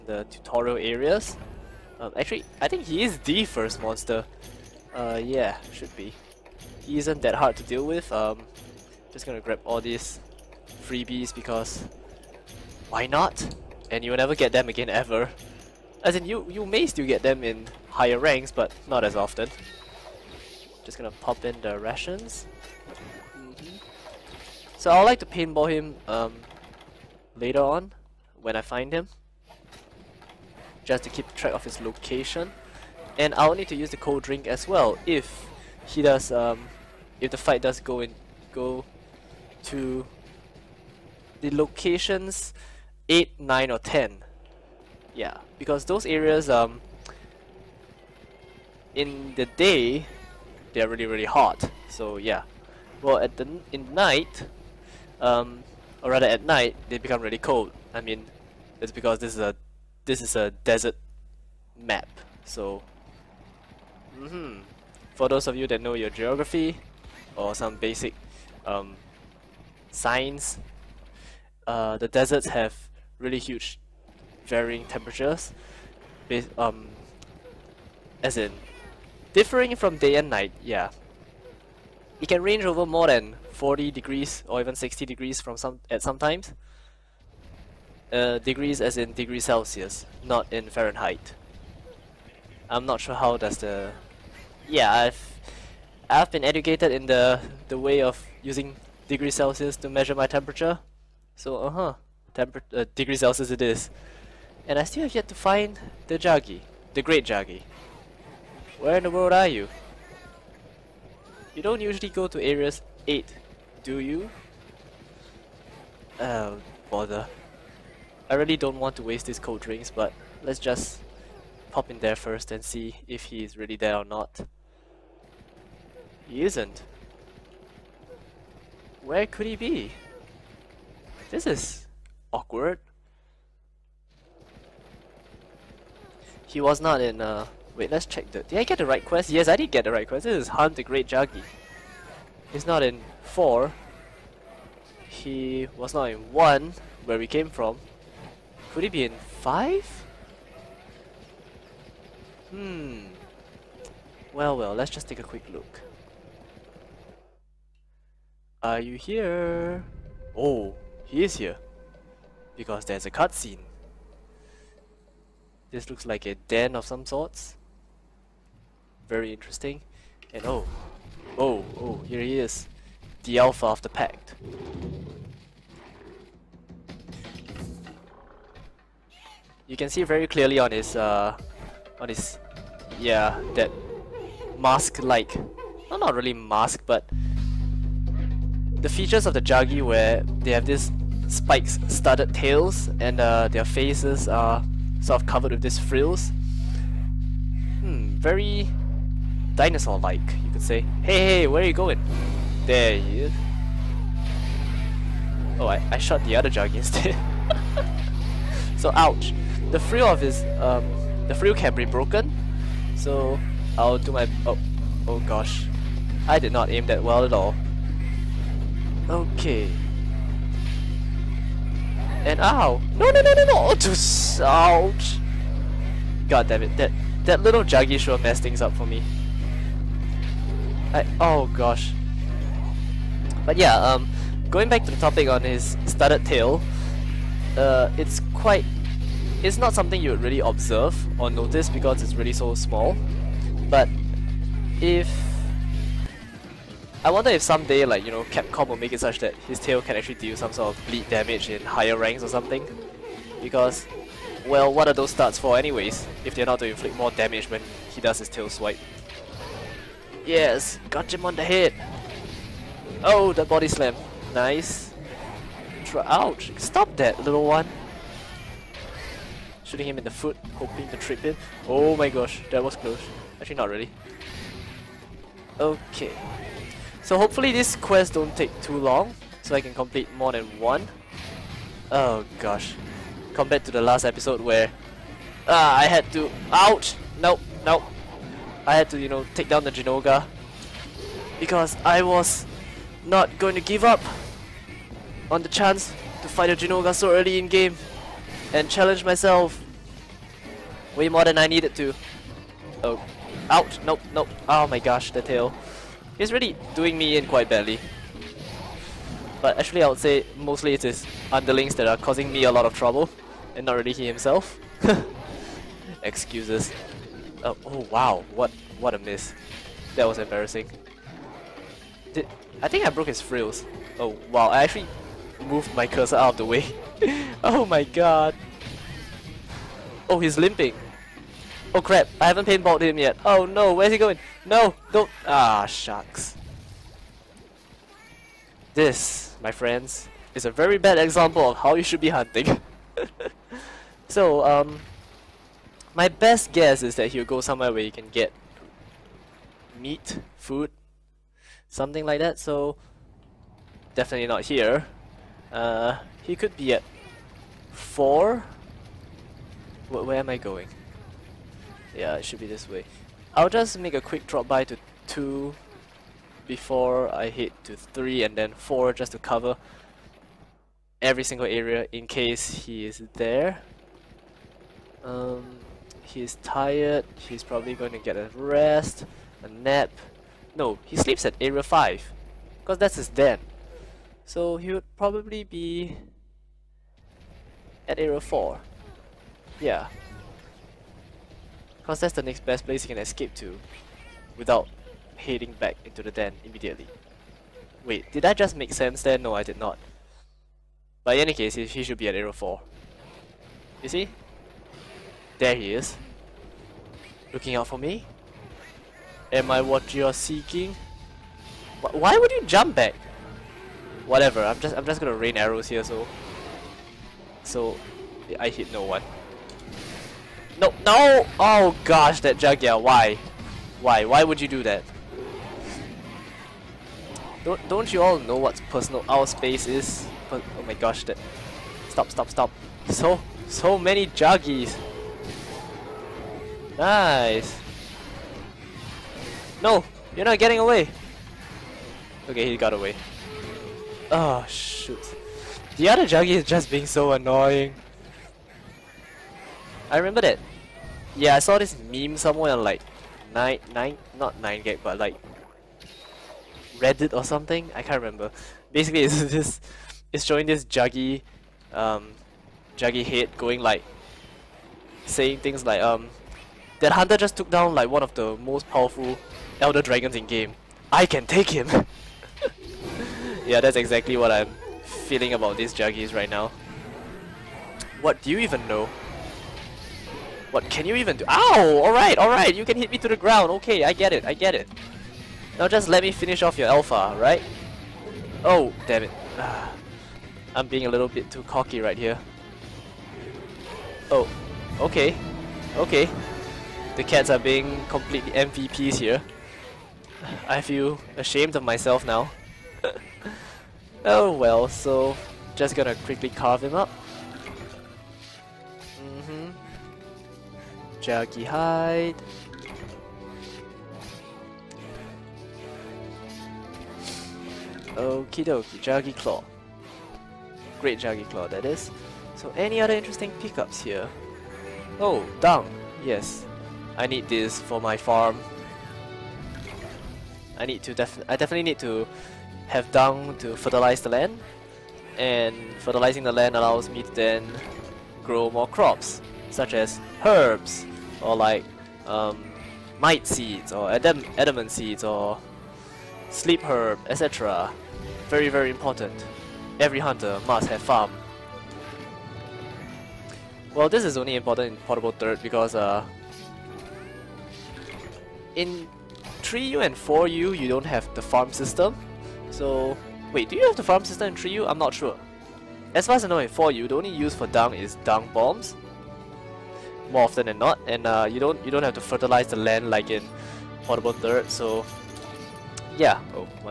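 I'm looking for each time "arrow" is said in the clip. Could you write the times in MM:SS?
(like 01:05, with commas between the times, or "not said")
06:42, 06:55.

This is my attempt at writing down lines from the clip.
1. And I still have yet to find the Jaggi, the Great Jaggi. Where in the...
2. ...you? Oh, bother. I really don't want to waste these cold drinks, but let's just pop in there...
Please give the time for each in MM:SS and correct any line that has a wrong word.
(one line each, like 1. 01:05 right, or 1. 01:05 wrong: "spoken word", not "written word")
1. 01:44 right
2. 01:53 right.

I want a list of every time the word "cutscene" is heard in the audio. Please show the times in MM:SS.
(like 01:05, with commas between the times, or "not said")
02:43.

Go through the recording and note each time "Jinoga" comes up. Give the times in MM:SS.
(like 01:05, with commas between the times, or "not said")
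04:49, 04:56.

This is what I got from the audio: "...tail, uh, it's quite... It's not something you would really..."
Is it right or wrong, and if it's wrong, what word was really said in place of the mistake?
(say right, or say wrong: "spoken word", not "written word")
right.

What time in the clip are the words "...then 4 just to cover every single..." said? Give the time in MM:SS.
06:08.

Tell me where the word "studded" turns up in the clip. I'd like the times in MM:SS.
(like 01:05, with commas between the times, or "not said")
03:11, 03:55.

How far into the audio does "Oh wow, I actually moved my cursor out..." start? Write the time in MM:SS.
05:23.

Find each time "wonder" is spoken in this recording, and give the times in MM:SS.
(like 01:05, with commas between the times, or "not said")
04:07.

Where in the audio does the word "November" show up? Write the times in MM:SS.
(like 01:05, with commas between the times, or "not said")
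not said.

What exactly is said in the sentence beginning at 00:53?
Well, at the in night um or rather at night they become really cold.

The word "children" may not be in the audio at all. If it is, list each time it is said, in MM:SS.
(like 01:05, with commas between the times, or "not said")
not said.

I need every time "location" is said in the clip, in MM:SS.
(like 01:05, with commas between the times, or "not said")
00:31, 00:41.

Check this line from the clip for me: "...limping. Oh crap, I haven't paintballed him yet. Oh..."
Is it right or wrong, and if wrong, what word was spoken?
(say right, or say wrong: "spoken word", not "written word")
right.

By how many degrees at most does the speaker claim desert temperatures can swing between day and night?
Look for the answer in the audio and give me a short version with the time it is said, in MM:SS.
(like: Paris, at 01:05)
60, at 01:24.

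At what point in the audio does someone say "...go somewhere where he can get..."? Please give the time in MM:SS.
05:47.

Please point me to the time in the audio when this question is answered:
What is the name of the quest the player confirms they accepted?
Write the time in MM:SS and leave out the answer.
02:20.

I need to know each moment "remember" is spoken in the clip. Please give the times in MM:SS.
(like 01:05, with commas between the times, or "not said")
07:29, 07:38.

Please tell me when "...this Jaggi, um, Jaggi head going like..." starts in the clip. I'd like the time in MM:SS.
07:40.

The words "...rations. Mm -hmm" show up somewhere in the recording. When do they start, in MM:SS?
00:21.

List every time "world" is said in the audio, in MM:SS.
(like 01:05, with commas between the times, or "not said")
01:49.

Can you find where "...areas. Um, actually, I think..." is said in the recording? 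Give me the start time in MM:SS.
00:00.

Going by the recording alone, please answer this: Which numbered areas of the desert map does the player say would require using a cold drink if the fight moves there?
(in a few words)
8, 9 or 10.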